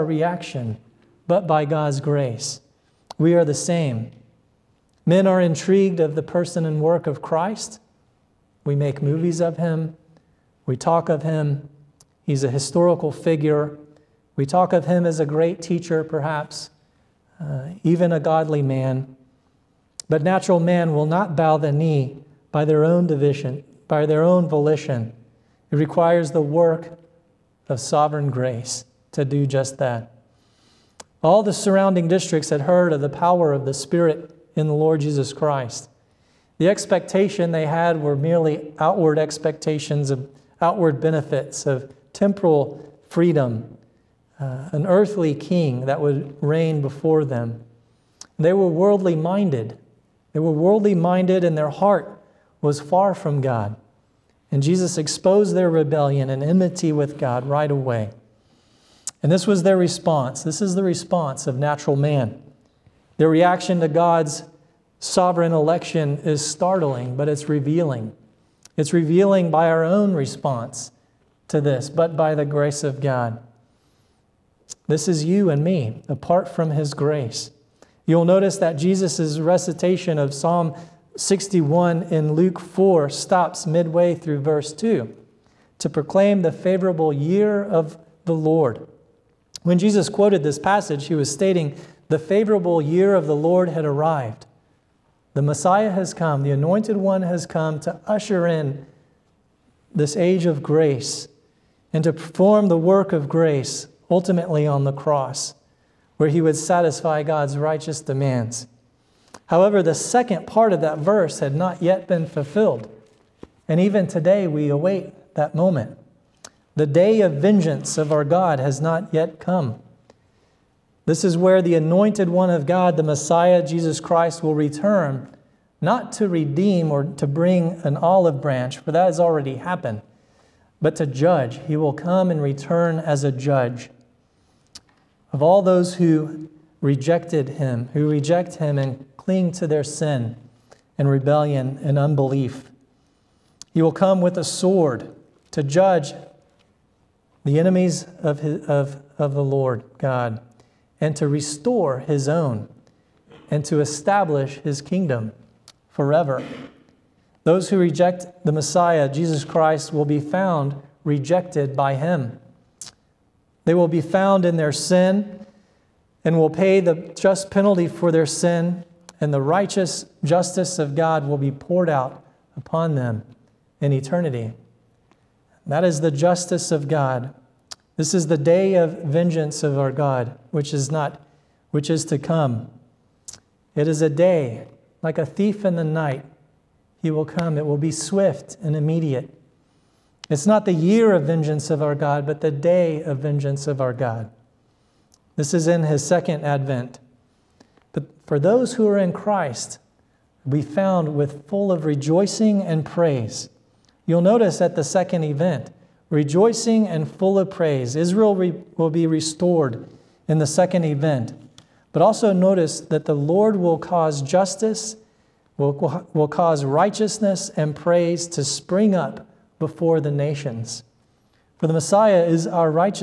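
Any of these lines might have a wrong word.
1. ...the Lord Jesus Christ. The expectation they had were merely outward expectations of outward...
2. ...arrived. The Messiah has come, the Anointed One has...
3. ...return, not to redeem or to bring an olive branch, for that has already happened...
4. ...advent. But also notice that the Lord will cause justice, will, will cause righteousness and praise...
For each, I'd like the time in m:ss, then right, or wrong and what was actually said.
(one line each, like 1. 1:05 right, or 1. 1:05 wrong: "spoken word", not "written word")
1. 0:34 right
2. 1:33 right
3. 2:04 right
4. 3:30 right.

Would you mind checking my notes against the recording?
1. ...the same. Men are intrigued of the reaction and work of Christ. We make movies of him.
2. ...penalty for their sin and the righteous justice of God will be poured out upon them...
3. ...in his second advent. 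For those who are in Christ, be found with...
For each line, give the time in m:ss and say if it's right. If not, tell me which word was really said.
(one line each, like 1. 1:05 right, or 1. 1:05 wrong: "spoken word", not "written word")
1. 0:03 wrong: "person", not "reaction"
2. 2:47 right
3. 3:15 right.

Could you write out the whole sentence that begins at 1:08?
It's revealing by our own response to this, but by the grace of God.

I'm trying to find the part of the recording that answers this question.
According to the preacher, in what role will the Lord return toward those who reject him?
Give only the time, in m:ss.
2:13.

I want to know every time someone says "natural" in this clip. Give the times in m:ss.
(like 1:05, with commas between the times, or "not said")
0:20, 1:01.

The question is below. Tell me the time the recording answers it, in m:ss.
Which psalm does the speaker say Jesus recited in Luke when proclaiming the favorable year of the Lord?
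1:20.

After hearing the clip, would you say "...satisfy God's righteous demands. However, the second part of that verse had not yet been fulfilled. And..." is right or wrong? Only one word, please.
right.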